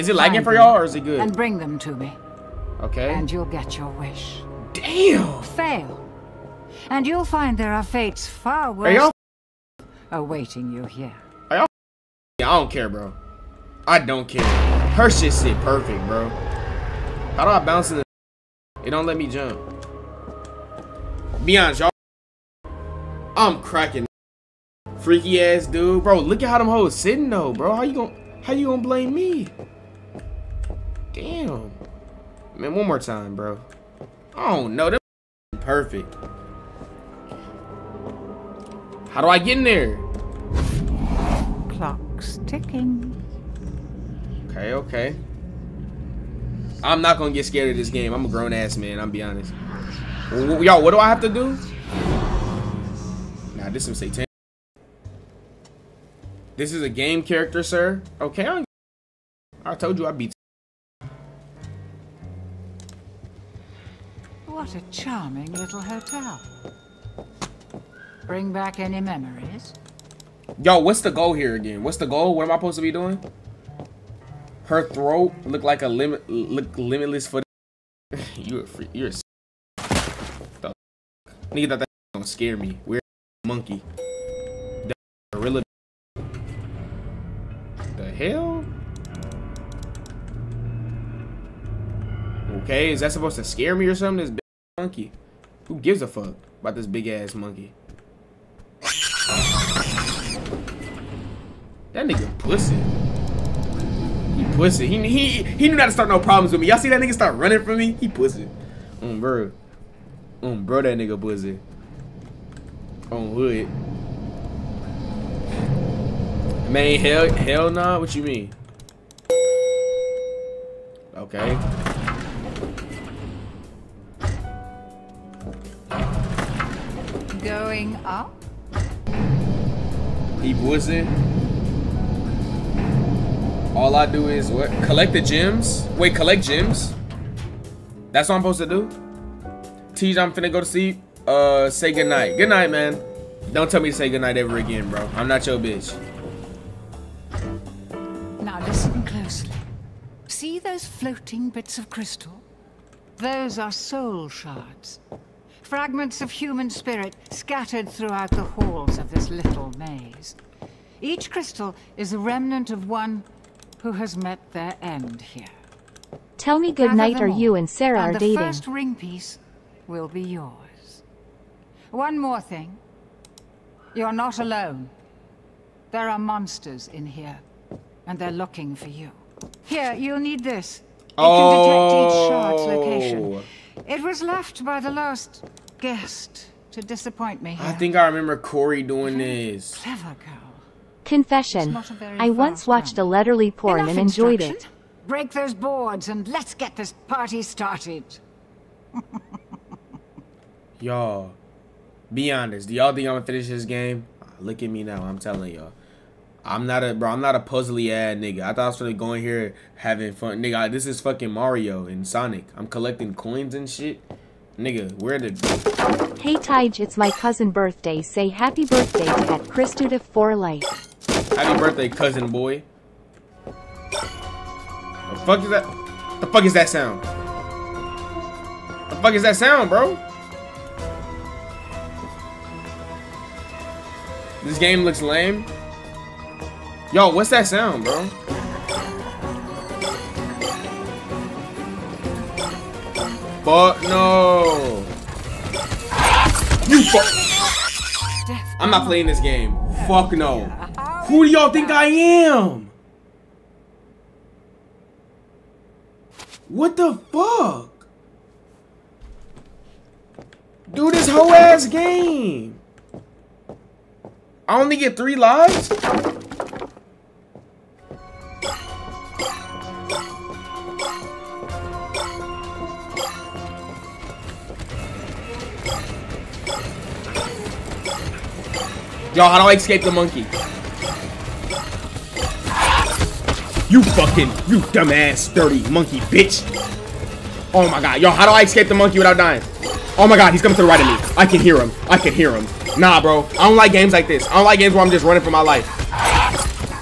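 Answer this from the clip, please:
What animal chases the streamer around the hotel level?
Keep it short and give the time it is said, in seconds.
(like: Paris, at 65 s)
Gorilla, at 84 s.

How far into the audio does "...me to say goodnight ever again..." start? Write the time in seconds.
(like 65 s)
143 s.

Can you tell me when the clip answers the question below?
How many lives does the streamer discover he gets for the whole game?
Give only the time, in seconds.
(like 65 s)
264 s.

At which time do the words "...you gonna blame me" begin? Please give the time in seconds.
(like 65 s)
28 s.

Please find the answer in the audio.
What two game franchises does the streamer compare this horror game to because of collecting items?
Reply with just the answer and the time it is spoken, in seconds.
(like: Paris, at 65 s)
Mario and Sonic, at 211 s.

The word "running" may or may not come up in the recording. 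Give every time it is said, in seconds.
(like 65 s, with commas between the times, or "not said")
107 s, 295 s.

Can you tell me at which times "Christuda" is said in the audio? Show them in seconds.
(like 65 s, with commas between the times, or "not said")
219 s.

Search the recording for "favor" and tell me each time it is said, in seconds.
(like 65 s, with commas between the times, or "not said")
not said.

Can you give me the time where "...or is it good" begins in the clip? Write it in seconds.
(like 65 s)
0 s.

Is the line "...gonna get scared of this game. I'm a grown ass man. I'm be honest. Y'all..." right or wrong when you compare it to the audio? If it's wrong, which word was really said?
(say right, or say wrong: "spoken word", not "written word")
right.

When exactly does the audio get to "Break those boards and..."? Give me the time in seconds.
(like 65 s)
195 s.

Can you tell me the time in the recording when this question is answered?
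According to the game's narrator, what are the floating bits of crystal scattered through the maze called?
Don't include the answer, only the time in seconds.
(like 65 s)
153 s.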